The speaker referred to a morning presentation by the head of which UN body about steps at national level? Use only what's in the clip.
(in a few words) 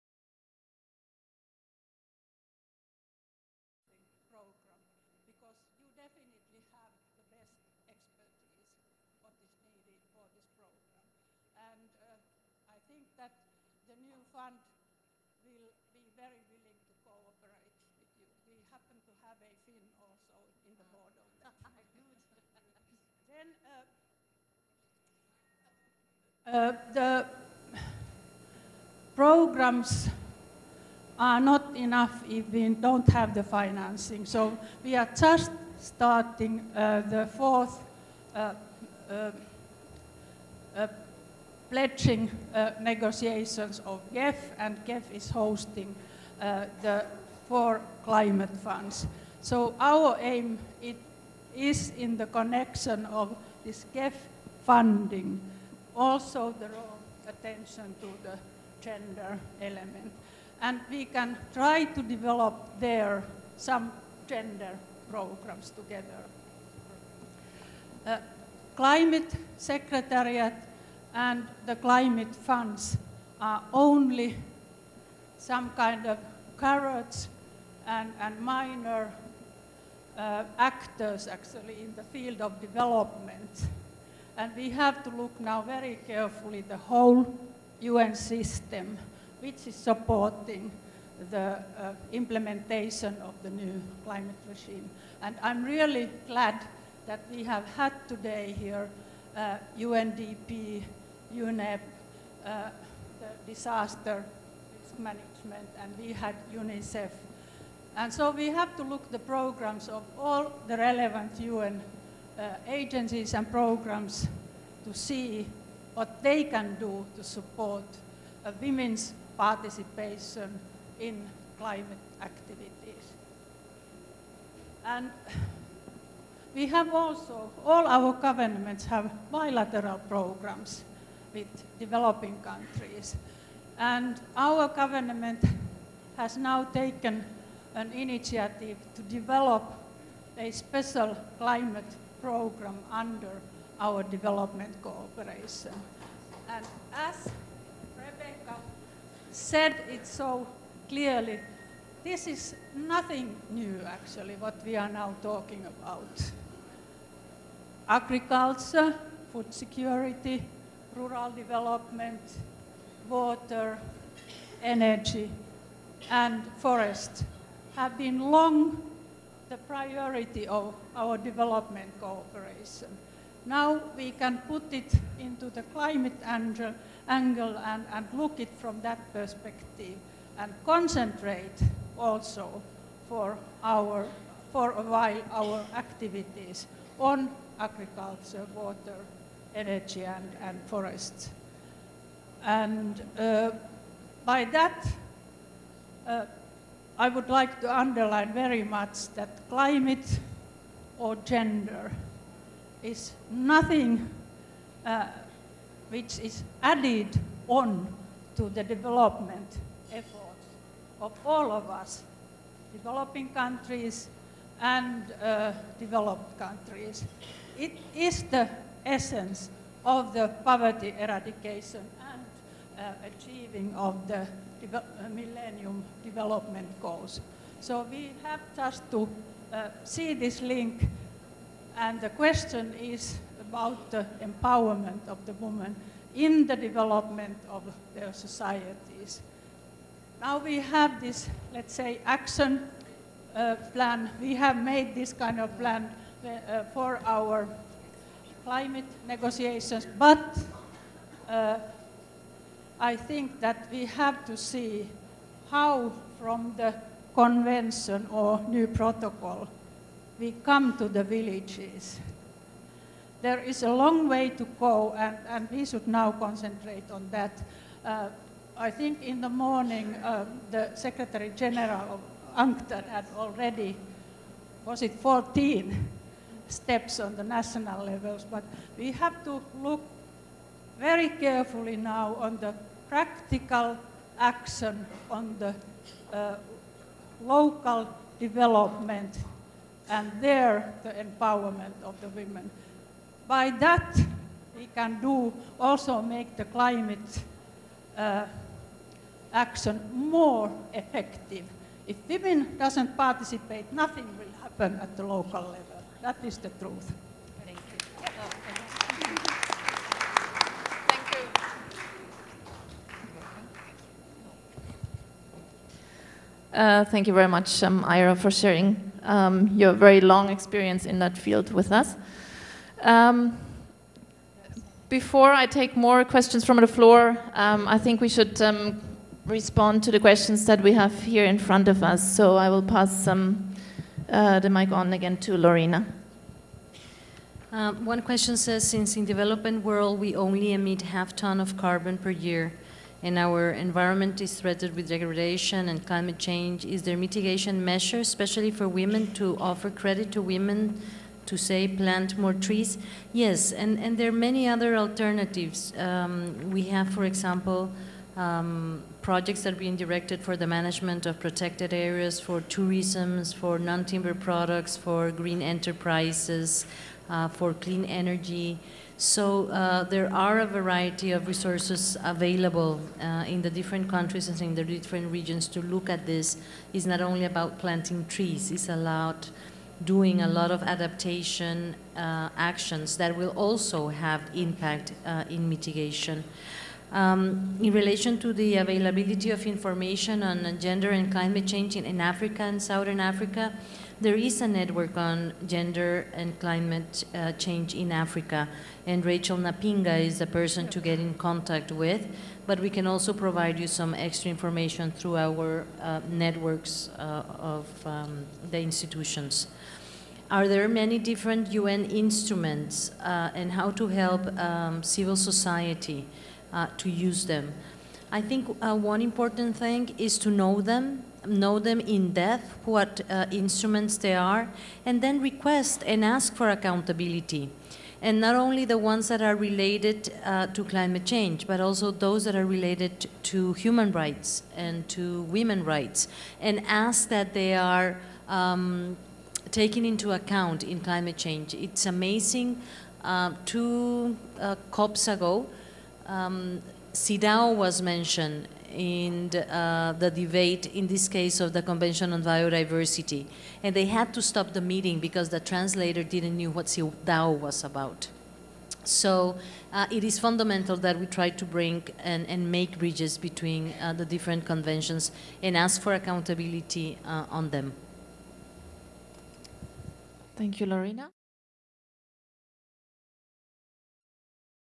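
UNCTAD.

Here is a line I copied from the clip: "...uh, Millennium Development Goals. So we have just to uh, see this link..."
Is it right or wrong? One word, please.
right.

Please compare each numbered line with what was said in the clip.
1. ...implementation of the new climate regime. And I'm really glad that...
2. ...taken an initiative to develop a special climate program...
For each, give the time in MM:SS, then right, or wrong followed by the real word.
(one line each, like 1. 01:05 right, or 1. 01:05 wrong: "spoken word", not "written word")
1. 01:32 right
2. 02:16 right.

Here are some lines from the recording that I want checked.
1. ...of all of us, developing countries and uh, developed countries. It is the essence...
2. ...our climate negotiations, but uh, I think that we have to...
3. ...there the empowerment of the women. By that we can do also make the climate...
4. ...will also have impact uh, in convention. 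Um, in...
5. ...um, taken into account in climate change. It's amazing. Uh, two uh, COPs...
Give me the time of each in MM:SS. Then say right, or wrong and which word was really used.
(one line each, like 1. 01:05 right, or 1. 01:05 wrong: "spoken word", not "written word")
1. 03:31 right
2. 04:07 right
3. 04:50 right
4. 06:23 wrong: "mitigation", not "convention"
5. 07:18 right.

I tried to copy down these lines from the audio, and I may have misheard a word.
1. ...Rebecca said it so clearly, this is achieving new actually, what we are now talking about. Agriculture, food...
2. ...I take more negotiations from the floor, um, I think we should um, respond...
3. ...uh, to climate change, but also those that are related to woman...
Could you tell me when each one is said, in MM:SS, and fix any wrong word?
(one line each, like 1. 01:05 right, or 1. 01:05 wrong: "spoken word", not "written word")
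1. 02:27 wrong: "nothing", not "achieving"
2. 05:25 wrong: "questions", not "negotiations"
3. 07:10 wrong: "human", not "woman".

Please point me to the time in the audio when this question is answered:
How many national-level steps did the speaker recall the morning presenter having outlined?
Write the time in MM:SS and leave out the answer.
04:34.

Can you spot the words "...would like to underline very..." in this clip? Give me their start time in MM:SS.
03:17.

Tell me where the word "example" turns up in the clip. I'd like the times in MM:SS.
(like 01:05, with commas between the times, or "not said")
05:57.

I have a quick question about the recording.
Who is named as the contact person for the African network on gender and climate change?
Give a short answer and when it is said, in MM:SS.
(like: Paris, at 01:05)
Rachel Napinga, at 06:39.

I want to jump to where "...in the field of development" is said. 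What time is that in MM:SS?
01:21.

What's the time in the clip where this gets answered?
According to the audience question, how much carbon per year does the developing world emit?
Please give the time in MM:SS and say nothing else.
05:40.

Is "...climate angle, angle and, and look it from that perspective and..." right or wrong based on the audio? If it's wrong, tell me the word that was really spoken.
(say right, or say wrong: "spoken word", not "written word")
right.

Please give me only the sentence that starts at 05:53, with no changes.
Yes, and, and there are many other alternatives.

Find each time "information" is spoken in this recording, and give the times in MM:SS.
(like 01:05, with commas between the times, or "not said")
06:29, 06:44.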